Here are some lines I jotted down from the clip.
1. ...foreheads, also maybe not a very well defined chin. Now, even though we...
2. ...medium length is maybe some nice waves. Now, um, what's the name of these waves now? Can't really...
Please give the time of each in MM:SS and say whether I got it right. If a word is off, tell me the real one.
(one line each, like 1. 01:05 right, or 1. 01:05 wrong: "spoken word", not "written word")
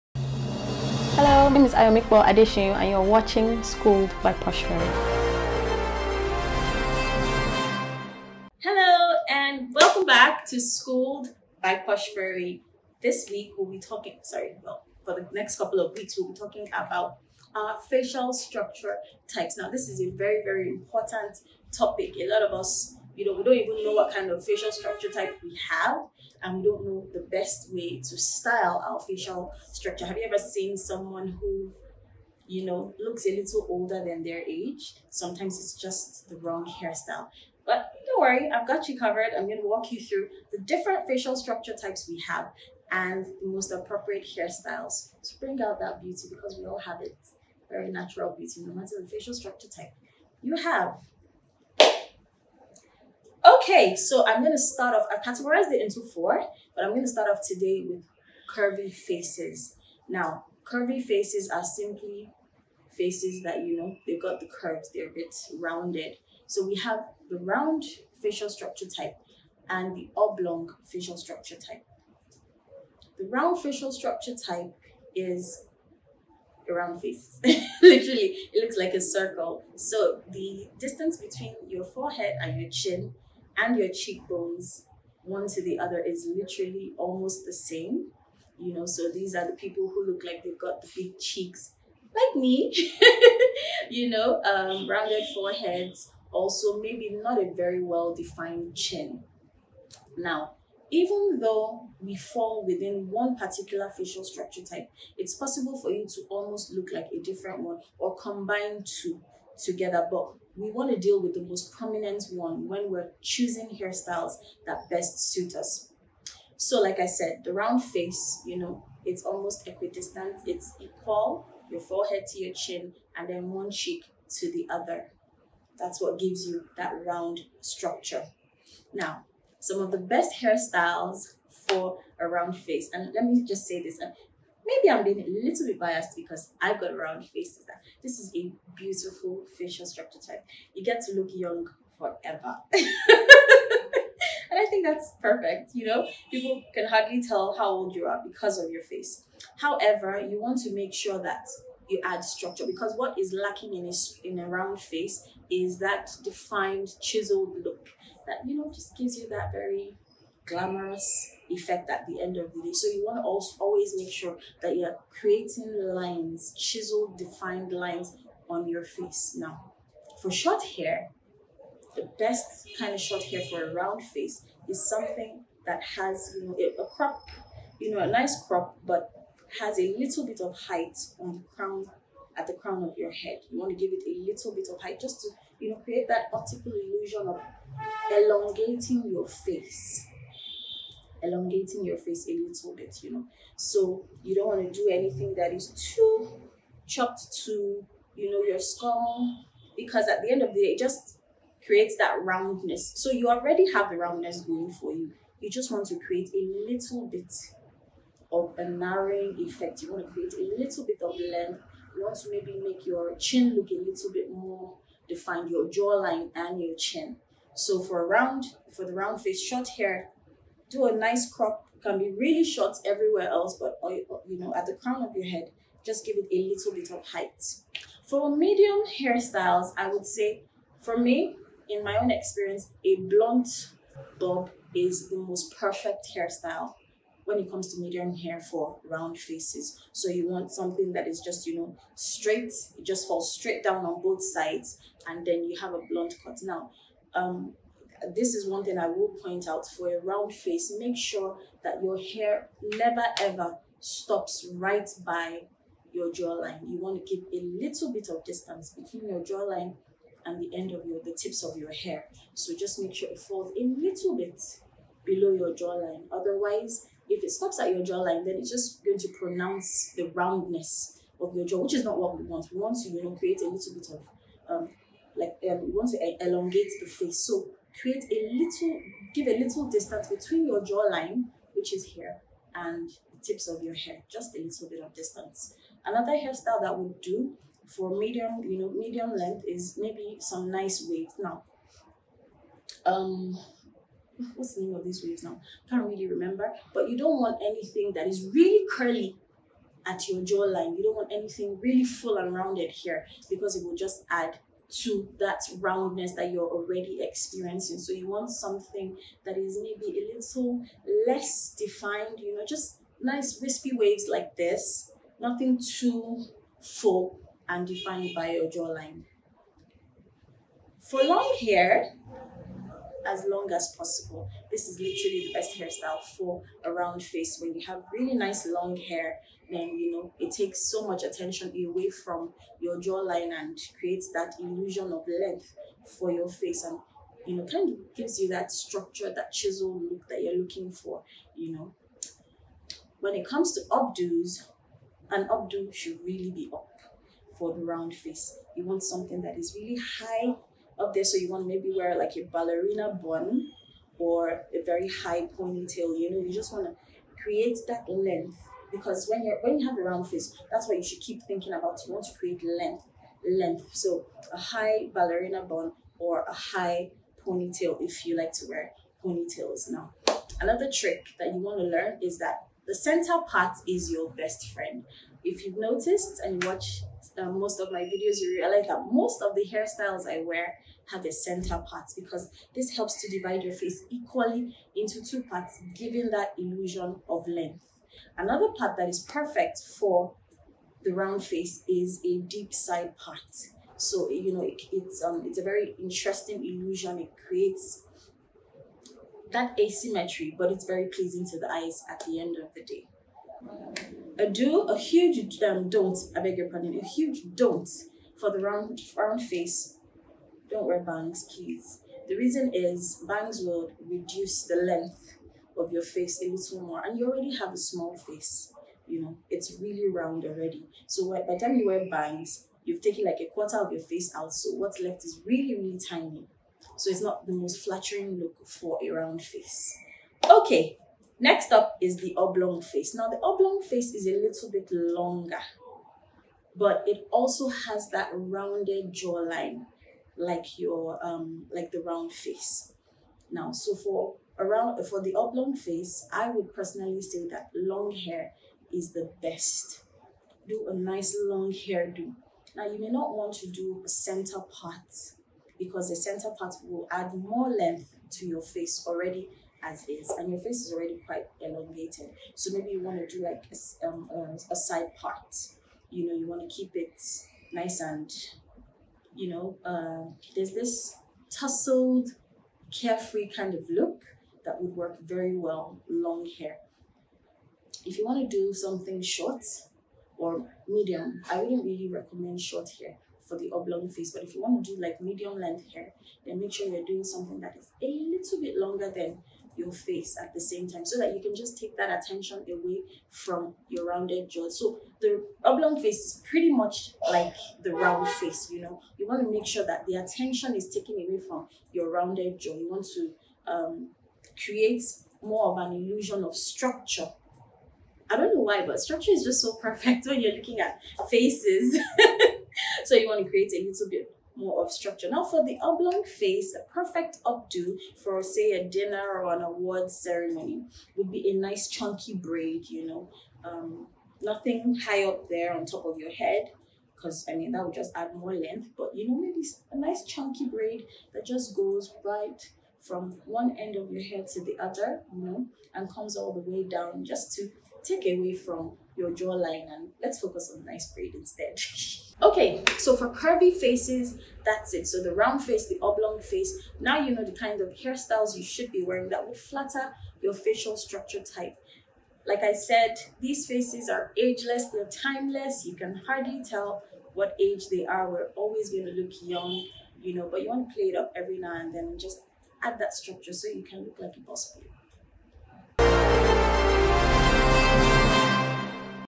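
1. 01:35 right
2. 04:48 right.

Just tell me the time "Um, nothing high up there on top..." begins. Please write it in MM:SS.
08:43.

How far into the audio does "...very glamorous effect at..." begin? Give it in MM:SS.
02:39.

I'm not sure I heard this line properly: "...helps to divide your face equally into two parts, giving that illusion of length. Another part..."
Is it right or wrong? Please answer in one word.
right.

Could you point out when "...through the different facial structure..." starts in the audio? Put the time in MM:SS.
00:40.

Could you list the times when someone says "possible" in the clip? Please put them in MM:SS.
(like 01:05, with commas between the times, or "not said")
01:45, 05:23.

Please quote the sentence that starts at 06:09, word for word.
Now, another trick that you want to learn is that the center part is your best friend.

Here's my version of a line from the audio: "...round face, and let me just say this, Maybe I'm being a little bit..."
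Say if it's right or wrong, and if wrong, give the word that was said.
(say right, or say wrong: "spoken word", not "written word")
right.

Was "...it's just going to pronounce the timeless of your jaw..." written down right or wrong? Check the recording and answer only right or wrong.
wrong.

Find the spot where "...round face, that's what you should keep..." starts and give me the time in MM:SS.
05:59.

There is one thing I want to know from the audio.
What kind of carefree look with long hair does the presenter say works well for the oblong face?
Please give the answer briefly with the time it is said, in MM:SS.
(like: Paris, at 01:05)
tousled, at 07:51.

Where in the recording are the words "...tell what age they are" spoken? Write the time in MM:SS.
09:16.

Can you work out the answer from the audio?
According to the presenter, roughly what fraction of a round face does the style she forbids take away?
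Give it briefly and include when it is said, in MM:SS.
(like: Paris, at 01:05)
a quarter, at 07:03.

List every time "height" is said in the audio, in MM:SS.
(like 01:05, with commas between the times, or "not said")
03:00, 03:04, 03:47.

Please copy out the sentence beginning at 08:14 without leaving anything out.
So the oblong face is pretty much like the round face, you know.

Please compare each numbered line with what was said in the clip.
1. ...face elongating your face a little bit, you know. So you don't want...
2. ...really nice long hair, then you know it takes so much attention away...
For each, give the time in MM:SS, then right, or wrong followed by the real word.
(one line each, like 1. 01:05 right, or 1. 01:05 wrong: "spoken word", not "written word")
1. 03:09 right
2. 05:27 right.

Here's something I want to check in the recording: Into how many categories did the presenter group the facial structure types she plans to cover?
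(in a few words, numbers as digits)
4.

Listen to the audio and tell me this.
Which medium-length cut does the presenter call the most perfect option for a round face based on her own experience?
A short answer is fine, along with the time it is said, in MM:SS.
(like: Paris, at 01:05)
blunt bob, at 03:52.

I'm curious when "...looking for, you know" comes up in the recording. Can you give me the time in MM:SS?
05:40.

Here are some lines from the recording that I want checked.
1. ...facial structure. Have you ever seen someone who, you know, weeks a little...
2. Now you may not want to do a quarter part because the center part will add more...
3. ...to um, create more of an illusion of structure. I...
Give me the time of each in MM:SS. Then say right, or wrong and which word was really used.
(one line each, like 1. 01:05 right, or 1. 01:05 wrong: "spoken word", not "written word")
1. 00:28 wrong: "looks", not "weeks"
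2. 07:32 wrong: "center", not "quarter"
3. 08:22 right.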